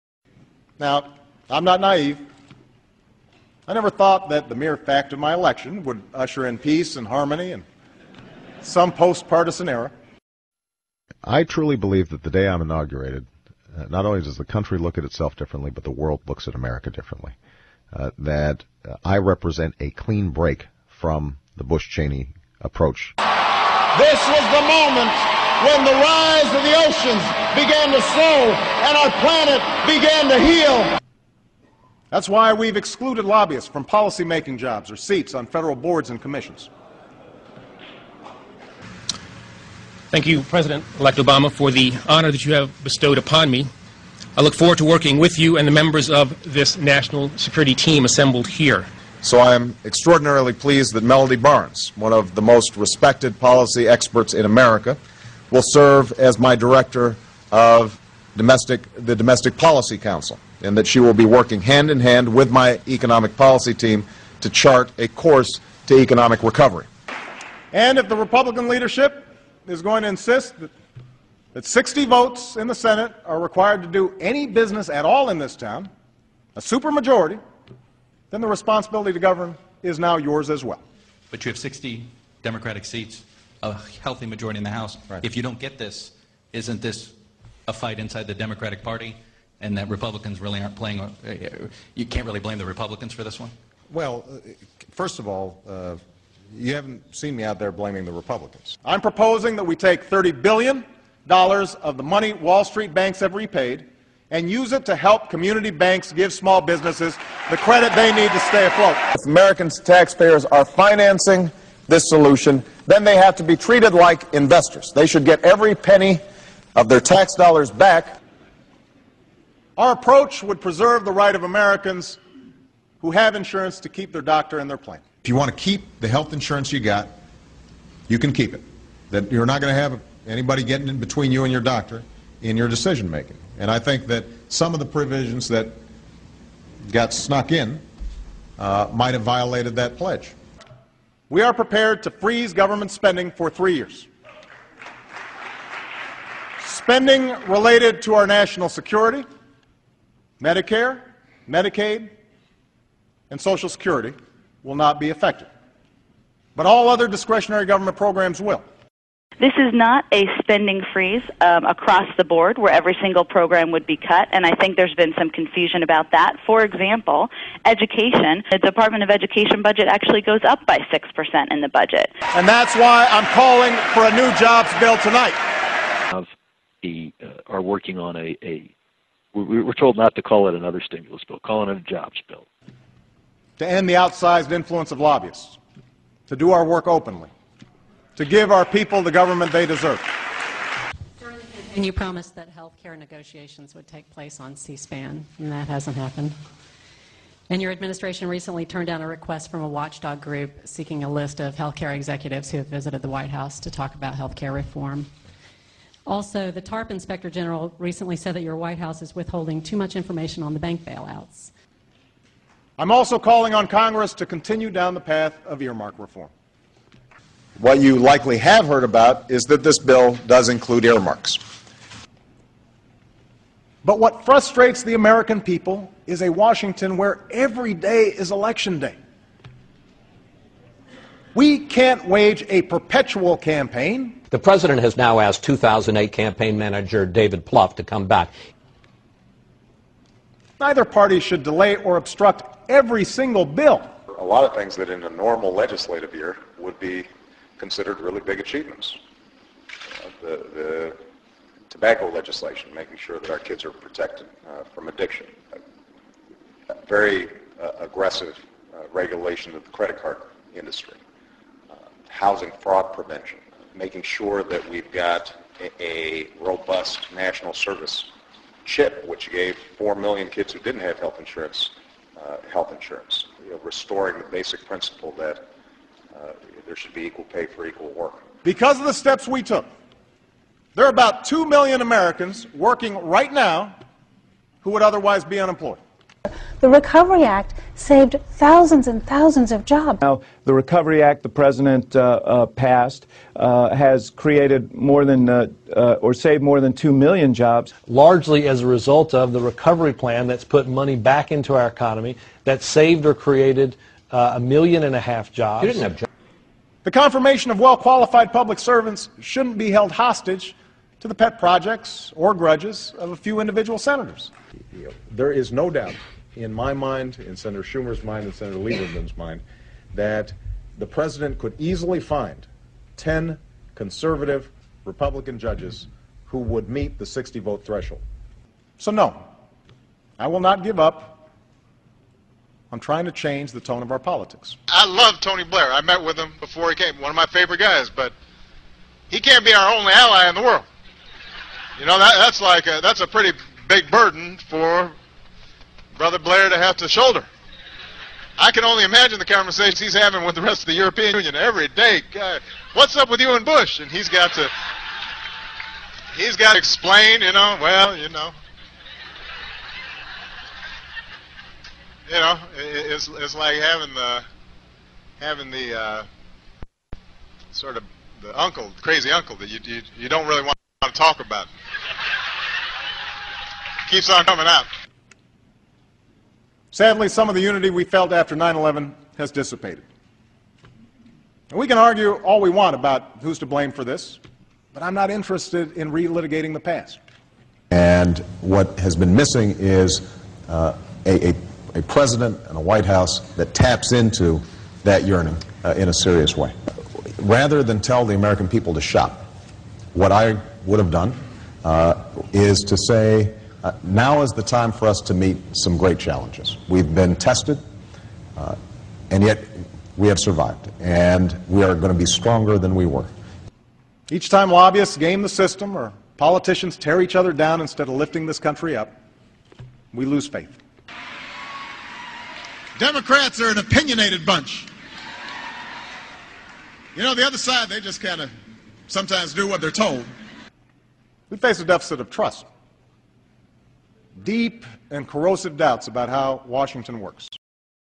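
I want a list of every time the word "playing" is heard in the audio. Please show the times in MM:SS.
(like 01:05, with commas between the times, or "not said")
01:30.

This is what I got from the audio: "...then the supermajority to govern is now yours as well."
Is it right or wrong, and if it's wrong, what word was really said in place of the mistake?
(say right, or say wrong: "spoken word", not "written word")
wrong: "responsibility", not "supermajority".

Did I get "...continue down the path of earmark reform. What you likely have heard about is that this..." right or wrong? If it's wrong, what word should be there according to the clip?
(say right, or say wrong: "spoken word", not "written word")
right.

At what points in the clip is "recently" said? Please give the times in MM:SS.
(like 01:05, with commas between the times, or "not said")
03:18, 03:27.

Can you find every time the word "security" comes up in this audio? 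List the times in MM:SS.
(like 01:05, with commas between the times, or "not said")
00:47, 02:28, 02:33.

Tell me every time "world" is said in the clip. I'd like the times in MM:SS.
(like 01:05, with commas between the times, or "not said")
00:15, 05:40.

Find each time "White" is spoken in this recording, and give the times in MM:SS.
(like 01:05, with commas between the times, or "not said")
03:23, 03:28, 06:32.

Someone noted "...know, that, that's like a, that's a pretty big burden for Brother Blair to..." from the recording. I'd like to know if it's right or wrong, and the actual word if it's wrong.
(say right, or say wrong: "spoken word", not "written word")
right.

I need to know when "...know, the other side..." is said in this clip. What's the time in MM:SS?
07:07.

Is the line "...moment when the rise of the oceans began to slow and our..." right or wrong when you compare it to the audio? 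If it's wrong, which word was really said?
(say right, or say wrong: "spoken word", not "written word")
right.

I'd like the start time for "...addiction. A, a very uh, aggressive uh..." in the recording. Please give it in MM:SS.
04:14.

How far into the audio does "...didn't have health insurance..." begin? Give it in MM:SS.
04:30.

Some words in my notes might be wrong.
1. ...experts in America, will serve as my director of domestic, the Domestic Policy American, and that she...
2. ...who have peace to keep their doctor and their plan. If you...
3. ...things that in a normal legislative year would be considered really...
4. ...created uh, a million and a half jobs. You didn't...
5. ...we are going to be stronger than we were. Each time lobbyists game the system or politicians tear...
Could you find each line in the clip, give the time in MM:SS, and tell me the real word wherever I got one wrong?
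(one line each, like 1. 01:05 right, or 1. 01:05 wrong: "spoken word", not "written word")
1. 00:53 wrong: "Council", not "American"
2. 02:03 wrong: "insurance", not "peace"
3. 04:04 right
4. 05:03 right
5. 06:51 right.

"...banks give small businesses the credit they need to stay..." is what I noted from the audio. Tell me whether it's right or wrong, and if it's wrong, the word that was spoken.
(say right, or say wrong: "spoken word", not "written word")
right.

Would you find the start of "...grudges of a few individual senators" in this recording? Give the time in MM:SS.
05:12.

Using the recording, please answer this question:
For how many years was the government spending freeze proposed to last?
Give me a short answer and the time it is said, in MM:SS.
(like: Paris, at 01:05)
3, at 02:23.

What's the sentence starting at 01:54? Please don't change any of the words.
They should get every penny of their tax dollars back.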